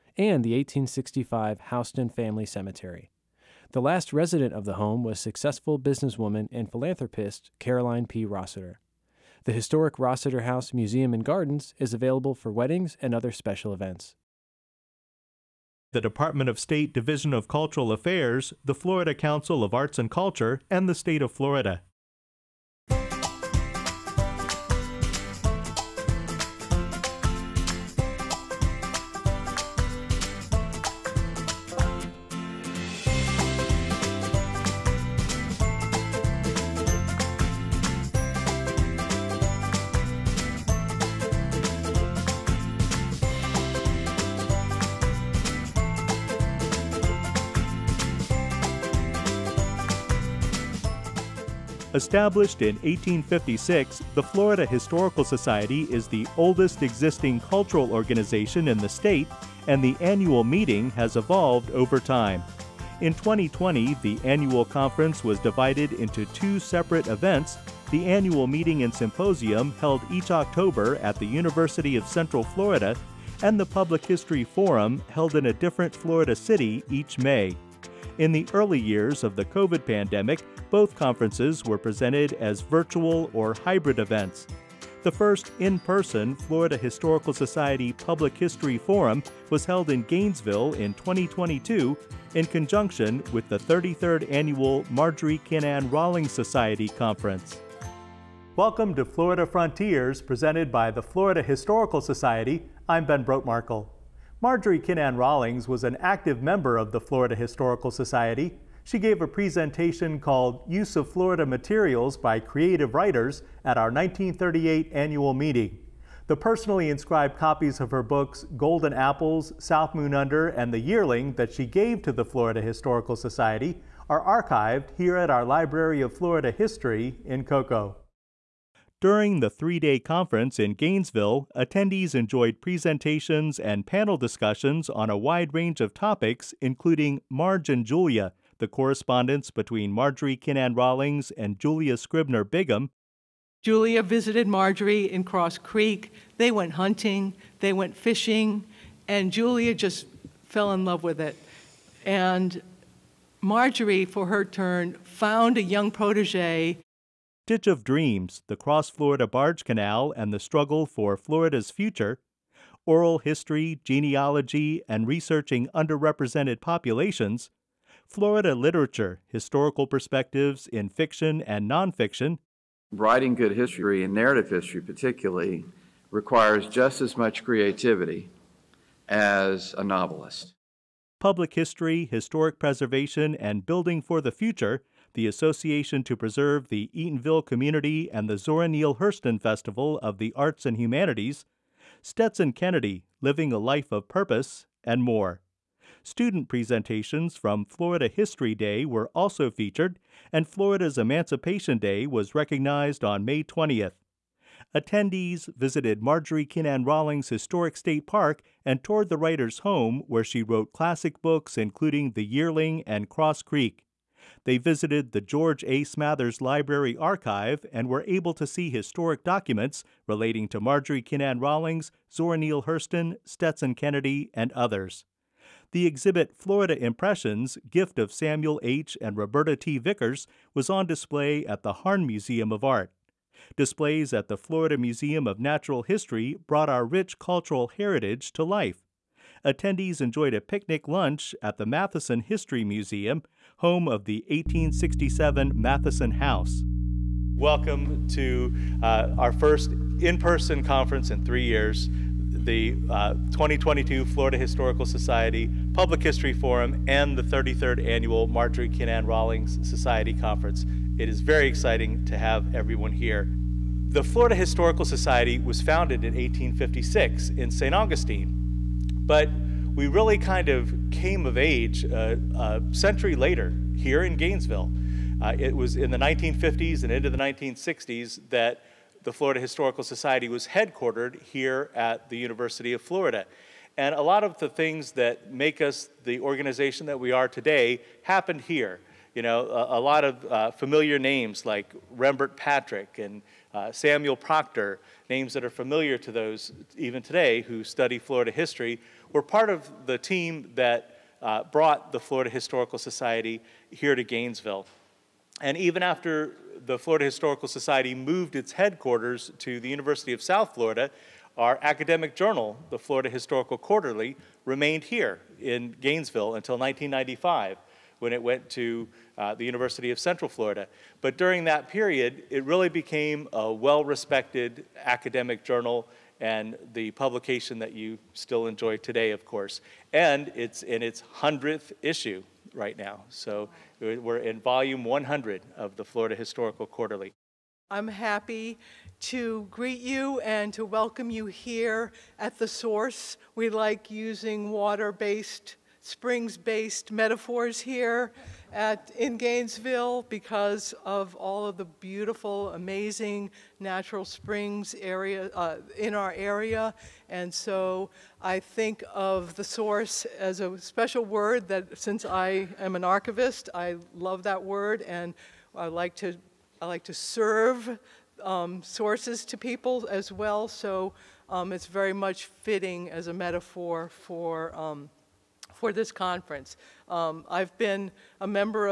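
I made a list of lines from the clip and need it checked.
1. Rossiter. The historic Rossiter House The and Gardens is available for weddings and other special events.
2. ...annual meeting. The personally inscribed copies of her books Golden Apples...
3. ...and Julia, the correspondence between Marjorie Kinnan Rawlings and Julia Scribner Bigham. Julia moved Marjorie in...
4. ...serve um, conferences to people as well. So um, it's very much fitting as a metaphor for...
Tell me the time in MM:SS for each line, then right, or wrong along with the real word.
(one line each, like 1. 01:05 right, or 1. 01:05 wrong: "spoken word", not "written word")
1. 00:08 wrong: "Museum", not "The"
2. 01:54 right
3. 02:17 wrong: "visited", not "moved"
4. 06:06 wrong: "sources", not "conferences".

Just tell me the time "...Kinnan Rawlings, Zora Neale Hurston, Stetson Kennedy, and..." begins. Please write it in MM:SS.
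03:41.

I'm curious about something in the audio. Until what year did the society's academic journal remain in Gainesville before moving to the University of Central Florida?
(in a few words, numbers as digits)
1995.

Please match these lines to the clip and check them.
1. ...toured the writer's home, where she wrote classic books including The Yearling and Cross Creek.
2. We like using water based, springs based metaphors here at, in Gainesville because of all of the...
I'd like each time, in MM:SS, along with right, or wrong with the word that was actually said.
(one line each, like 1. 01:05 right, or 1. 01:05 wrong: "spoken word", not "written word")
1. 03:28 right
2. 05:43 right.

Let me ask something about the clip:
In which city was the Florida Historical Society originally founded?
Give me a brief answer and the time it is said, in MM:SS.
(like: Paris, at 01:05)
St. Augustine, at 04:27.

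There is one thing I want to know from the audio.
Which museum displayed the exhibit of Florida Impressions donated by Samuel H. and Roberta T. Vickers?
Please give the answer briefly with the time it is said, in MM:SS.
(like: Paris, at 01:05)
Harn Museum of Art, at 03:51.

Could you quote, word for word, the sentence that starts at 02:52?
Writing good history and narrative history, particularly, requires just as much creativity as a novelist.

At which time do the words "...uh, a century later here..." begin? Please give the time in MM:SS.
04:31.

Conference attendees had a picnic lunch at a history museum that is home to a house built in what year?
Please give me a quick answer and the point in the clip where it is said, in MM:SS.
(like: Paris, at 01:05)
1867, at 04:04.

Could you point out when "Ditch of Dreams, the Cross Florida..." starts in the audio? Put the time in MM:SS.
02:37.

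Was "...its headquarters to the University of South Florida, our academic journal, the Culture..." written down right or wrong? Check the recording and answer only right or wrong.
wrong.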